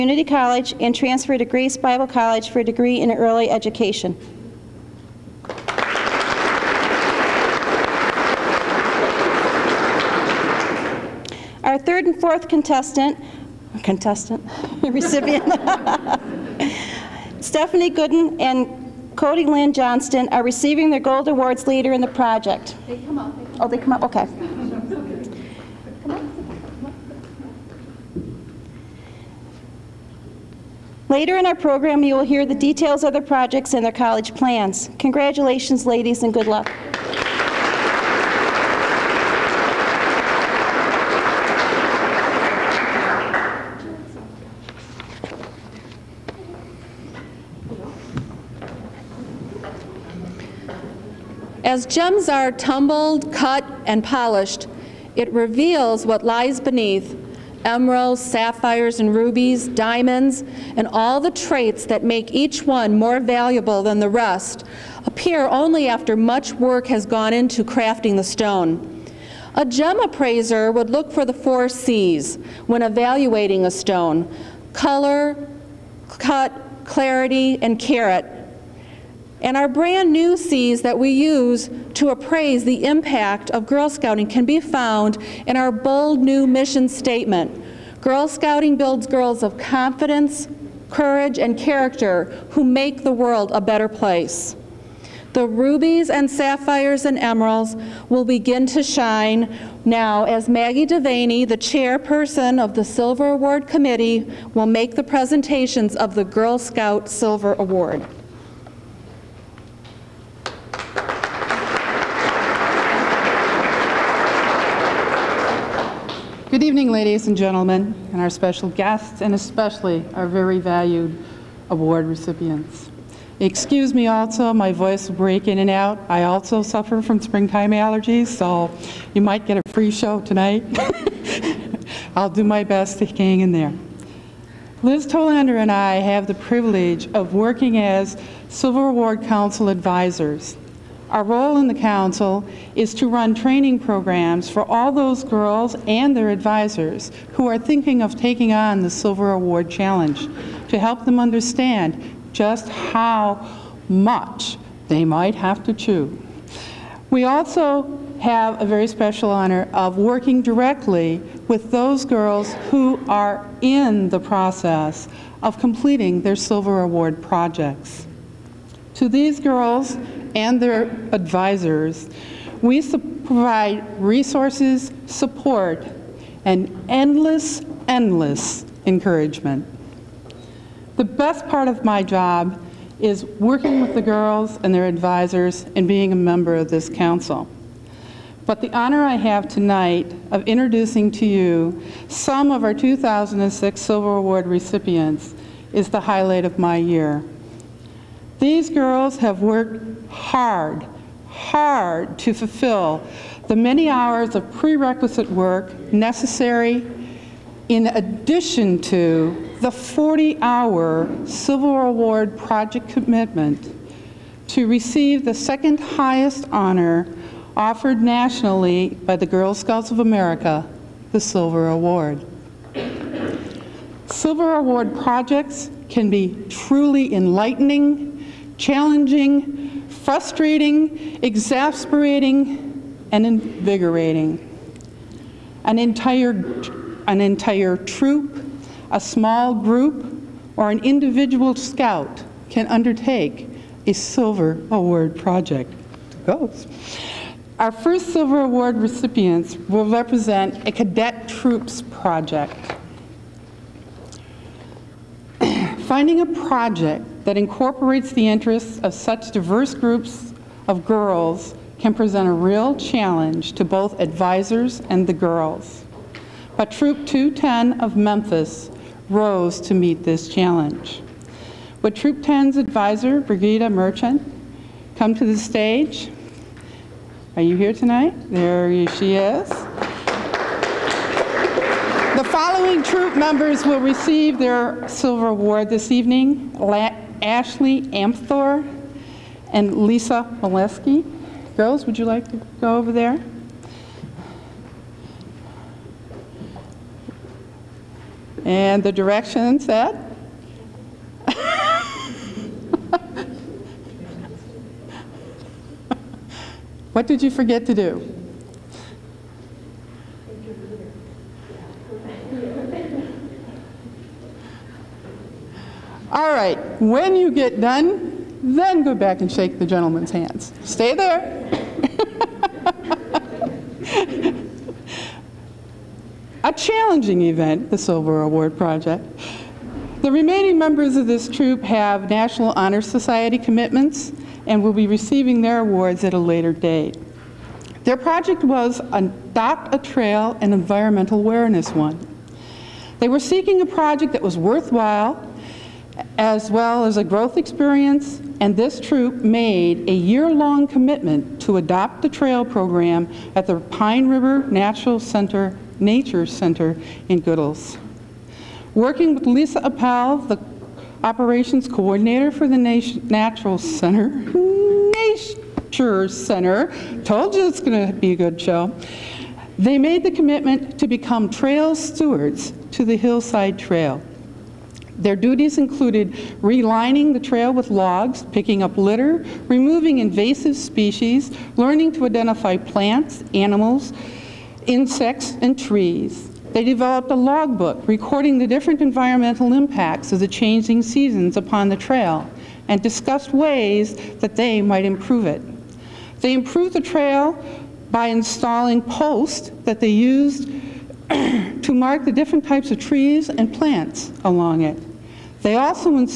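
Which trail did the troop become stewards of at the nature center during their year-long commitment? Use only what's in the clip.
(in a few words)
Hillside Trail.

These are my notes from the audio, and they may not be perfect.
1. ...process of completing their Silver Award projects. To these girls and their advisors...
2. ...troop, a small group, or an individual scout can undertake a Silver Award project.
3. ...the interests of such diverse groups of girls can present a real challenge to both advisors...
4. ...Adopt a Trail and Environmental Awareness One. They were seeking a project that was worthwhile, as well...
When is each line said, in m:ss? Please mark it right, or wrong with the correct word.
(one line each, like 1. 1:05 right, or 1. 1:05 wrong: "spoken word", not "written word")
1. 2:44 right
2. 3:57 right
3. 4:18 right
4. 5:38 right.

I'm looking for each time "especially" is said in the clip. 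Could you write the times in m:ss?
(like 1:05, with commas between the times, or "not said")
1:59.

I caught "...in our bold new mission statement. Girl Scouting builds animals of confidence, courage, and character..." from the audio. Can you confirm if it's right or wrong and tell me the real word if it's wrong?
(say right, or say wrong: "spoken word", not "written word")
wrong: "girls", not "animals".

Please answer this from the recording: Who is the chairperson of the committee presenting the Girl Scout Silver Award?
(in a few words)
Maggie Devaney.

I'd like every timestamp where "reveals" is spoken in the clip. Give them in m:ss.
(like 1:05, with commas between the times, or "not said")
0:55.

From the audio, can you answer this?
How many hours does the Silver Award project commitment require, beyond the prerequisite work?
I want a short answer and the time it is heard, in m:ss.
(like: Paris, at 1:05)
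40, at 3:29.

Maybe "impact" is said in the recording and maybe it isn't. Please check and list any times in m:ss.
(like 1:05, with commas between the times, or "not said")
1:22, 6:29.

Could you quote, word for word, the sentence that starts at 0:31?
Later in our program, you will hear the details of the projects and their college plans.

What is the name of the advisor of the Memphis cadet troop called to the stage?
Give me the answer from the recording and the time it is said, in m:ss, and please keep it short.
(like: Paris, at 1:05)
Brigida Merchant, at 4:33.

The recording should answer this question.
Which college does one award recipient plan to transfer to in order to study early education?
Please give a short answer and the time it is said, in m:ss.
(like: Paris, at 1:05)
Grace Bible College, at 0:01.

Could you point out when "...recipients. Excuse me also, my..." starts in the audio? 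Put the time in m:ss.
2:02.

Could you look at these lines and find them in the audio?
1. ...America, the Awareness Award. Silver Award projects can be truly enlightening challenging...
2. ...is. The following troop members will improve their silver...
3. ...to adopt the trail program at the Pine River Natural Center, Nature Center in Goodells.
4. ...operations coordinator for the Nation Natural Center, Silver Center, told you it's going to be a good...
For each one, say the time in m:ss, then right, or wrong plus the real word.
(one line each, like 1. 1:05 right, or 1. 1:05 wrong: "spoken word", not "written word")
1. 3:39 wrong: "Silver", not "Awareness"
2. 4:39 wrong: "receive", not "improve"
3. 5:51 right
4. 6:01 wrong: "Nature", not "Silver".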